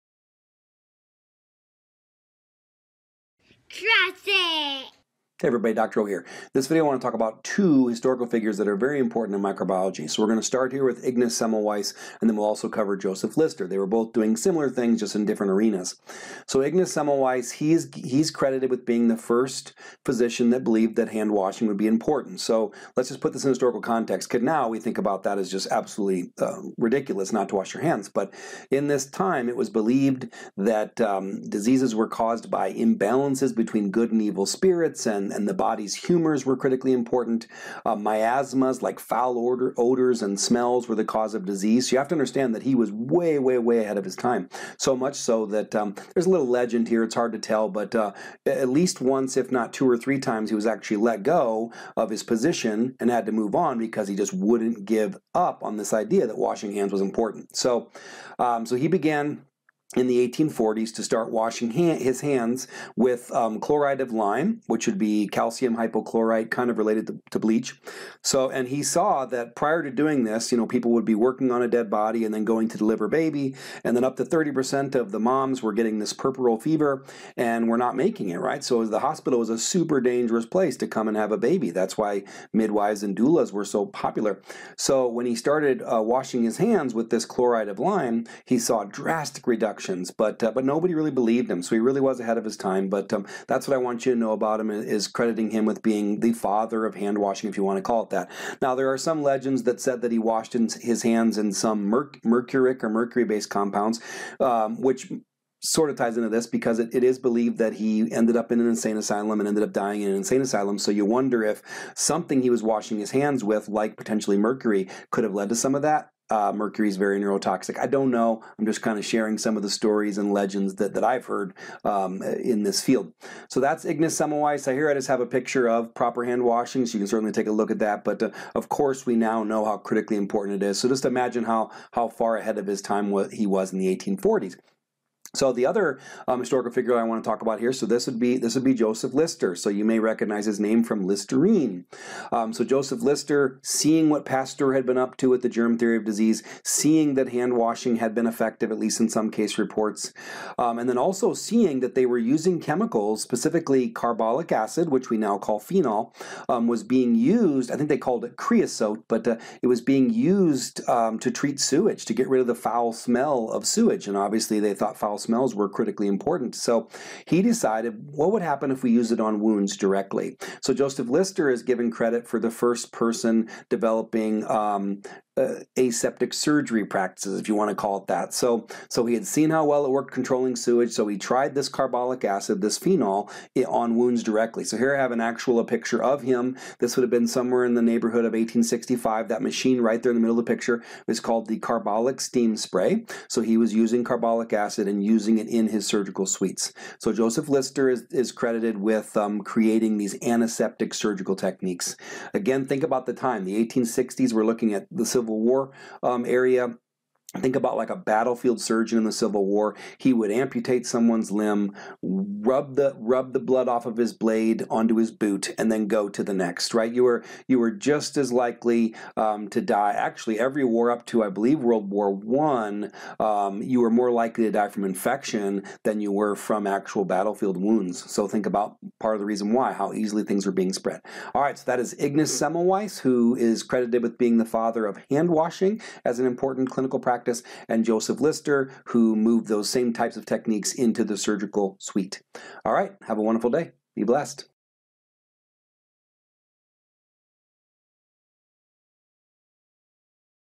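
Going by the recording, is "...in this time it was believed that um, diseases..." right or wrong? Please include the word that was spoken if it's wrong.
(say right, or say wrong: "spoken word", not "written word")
right.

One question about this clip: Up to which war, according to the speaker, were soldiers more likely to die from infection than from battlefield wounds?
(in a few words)
World War One.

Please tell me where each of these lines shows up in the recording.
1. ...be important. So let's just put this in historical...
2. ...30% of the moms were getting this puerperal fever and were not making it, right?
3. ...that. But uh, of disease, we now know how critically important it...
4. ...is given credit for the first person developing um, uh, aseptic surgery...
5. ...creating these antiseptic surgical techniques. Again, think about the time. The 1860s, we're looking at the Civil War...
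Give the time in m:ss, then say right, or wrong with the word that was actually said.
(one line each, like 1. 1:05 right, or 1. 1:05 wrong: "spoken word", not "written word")
1. 0:21 right
2. 1:14 right
3. 2:07 wrong: "course", not "disease"
4. 2:51 right
5. 3:19 right.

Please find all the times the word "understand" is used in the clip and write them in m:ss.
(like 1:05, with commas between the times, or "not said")
0:42.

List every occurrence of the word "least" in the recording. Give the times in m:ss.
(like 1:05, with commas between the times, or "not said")
0:48, 2:28.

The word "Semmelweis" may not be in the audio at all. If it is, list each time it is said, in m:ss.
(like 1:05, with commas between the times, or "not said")
0:11, 0:16, 2:04, 3:52.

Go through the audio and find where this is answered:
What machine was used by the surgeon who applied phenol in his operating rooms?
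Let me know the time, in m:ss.
3:11.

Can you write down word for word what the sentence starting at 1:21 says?
That's why midwives and doulas were so popular.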